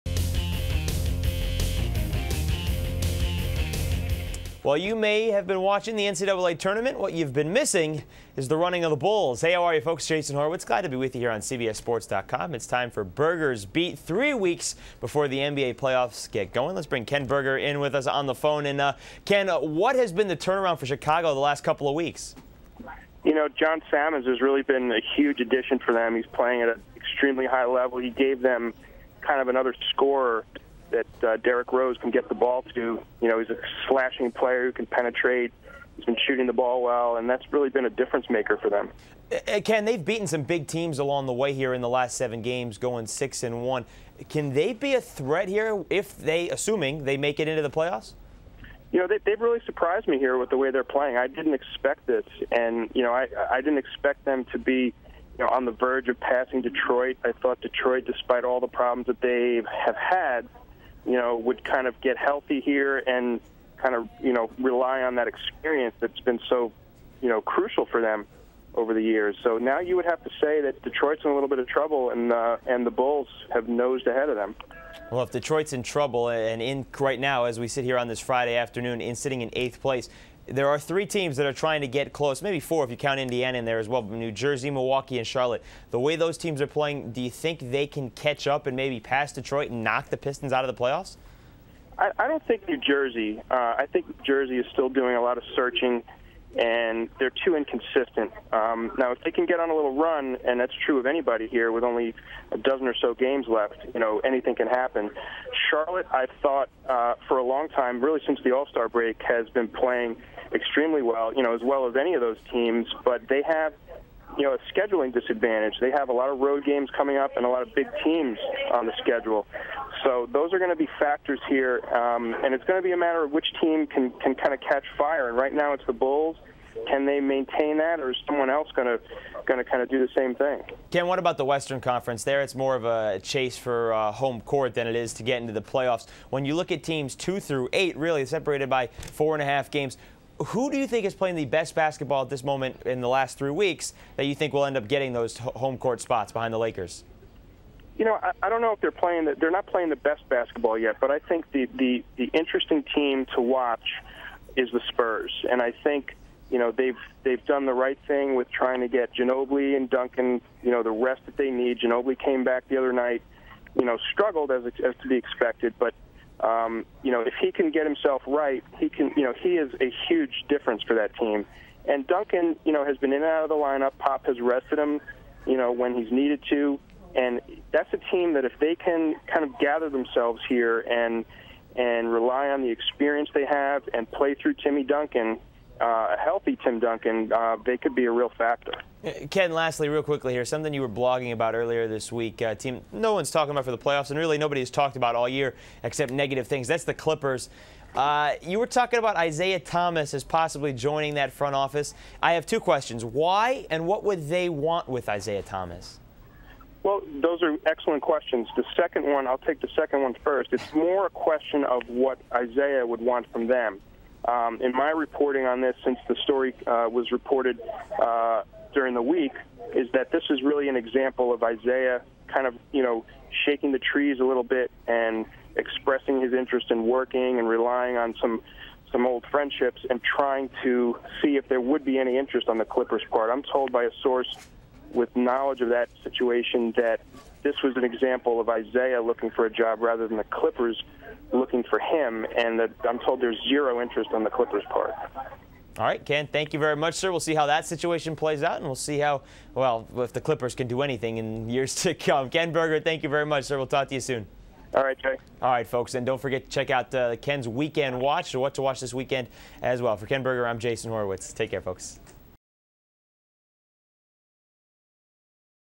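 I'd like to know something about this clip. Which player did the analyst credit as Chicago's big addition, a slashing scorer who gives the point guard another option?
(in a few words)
John Salmons.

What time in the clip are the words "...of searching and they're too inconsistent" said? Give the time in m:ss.
1:35.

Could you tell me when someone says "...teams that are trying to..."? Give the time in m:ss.
1:21.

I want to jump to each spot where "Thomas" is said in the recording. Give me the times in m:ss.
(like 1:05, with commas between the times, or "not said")
3:19, 3:25.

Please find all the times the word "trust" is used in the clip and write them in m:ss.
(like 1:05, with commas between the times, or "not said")
not said.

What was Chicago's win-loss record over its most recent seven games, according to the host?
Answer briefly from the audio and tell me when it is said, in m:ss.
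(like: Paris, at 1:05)
6-1, at 0:43.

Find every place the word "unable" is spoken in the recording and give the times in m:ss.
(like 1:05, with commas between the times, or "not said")
not said.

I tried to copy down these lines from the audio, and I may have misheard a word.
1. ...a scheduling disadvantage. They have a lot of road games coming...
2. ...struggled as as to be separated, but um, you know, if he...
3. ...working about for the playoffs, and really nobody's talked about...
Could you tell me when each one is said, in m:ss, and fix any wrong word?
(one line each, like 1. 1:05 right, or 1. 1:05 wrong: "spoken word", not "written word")
1. 1:54 right
2. 2:44 wrong: "expected", not "separated"
3. 3:13 wrong: "talking", not "working".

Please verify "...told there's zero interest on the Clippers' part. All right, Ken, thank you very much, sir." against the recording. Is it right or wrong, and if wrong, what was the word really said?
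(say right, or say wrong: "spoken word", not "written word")
right.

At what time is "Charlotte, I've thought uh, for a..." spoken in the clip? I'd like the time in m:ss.
1:45.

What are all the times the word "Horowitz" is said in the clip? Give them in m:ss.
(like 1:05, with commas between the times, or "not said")
0:10, 4:20.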